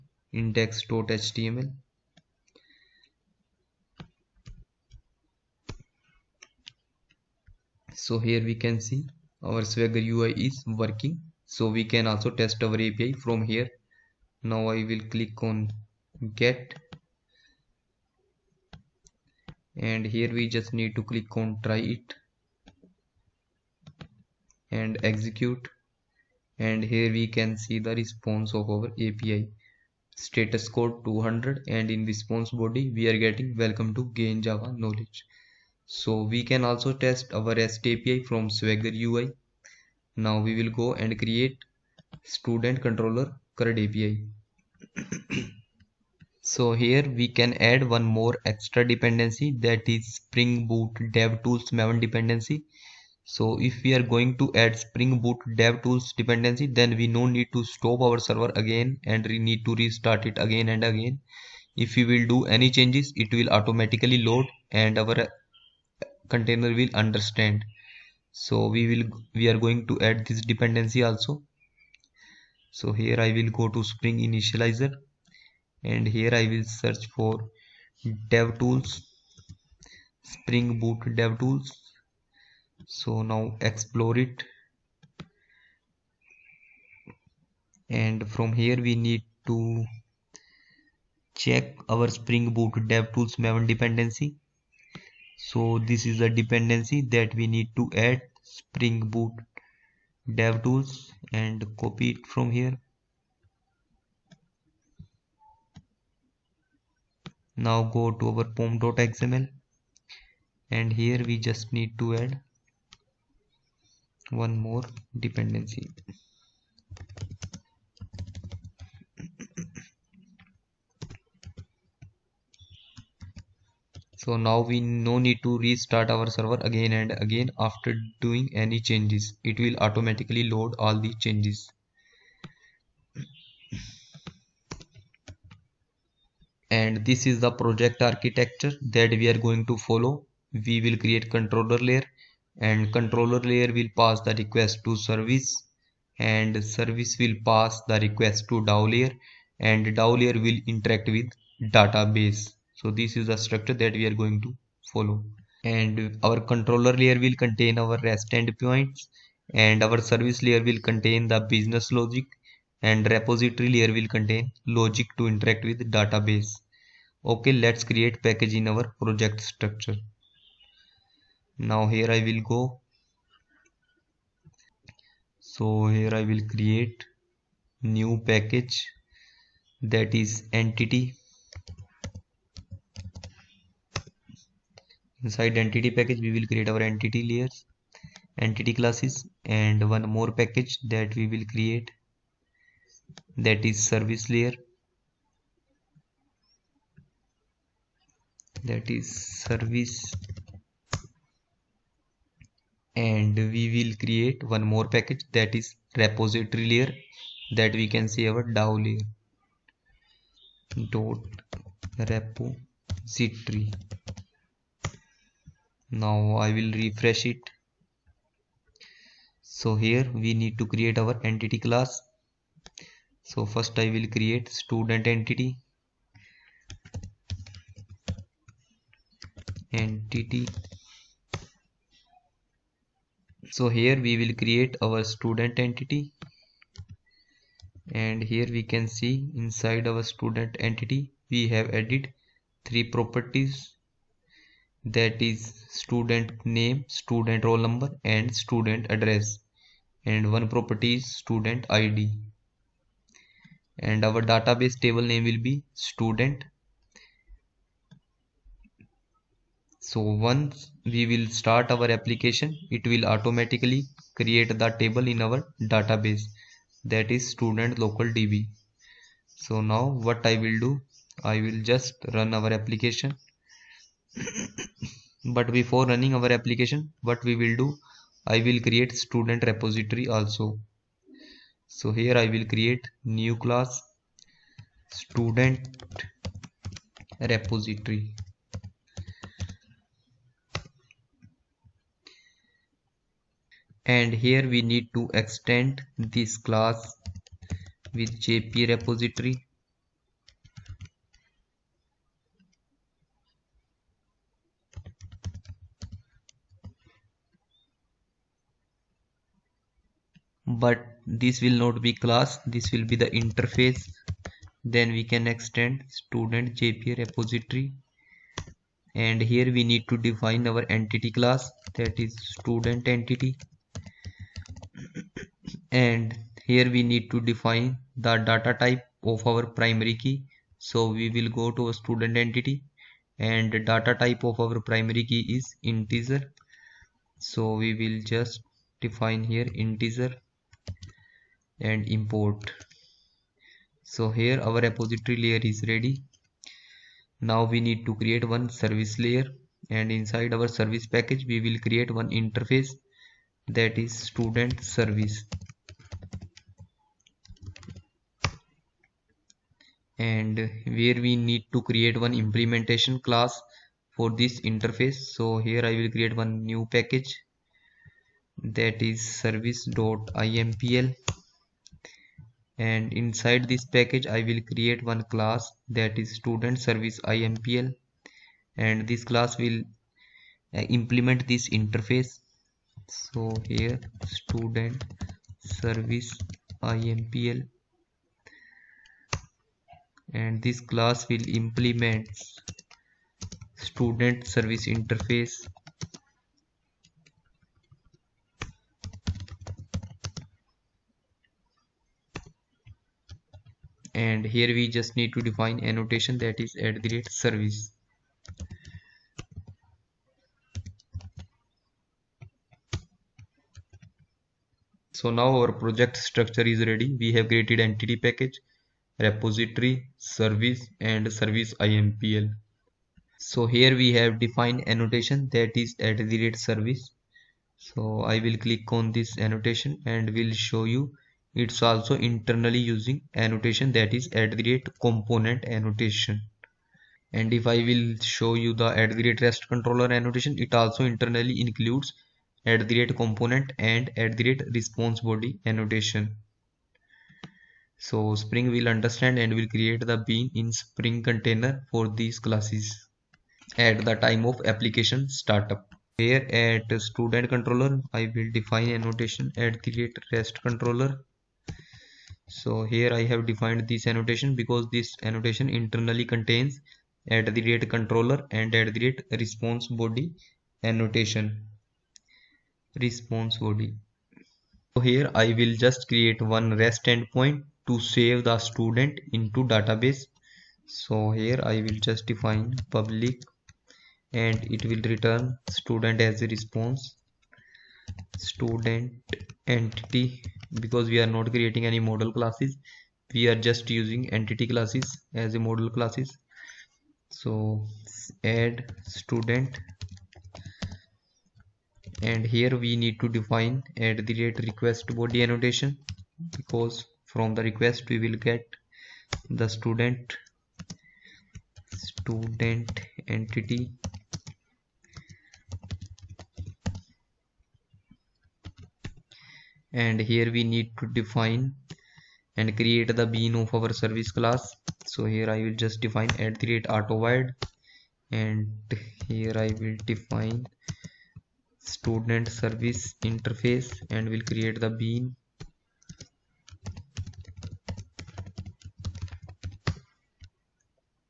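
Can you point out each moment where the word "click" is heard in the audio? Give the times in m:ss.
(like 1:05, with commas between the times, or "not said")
0:15, 0:21, 7:08.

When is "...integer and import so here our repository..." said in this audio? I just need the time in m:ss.
5:39.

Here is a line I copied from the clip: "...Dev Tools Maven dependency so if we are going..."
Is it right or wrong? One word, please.
right.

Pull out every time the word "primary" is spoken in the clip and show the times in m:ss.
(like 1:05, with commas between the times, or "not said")
5:29, 5:34.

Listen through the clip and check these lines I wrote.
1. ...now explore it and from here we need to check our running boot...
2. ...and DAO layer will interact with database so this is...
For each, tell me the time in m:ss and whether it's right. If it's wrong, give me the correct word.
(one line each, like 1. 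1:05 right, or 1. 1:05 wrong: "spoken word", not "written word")
1. 1:23 wrong: "spring", not "running"
2. 2:29 right.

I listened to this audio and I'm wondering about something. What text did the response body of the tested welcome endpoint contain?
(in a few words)
welcome to gain java knowledge.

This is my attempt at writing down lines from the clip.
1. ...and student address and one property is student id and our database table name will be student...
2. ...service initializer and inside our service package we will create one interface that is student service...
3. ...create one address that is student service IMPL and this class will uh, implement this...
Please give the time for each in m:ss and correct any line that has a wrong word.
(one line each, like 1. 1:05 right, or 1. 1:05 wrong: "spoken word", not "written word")
1. 4:08 right
2. 5:48 wrong: "layer", not "initializer"
3. 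6:14 wrong: "class", not "address".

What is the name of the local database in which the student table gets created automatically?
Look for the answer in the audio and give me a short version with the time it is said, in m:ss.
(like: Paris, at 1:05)
student local db, at 4:27.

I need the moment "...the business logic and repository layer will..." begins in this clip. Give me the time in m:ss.
2:41.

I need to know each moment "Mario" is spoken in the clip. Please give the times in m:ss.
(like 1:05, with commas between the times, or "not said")
not said.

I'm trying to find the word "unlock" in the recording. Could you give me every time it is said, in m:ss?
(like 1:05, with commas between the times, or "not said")
not said.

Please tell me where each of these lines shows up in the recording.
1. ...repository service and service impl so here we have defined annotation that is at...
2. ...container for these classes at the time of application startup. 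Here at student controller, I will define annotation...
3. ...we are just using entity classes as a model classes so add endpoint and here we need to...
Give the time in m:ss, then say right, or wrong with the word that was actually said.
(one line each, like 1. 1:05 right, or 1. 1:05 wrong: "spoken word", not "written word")
1. 6:59 right
2. 7:31 right
3. 8:13 wrong: "student", not "endpoint".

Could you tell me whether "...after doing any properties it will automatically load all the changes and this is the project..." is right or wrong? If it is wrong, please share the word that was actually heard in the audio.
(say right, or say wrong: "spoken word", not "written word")
wrong: "changes", not "properties".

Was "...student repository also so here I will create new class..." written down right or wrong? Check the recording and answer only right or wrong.
right.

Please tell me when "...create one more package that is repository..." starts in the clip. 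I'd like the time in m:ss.
3:24.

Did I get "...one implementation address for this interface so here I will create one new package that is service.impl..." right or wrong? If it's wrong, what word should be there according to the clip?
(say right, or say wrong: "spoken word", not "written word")
wrong: "class", not "address".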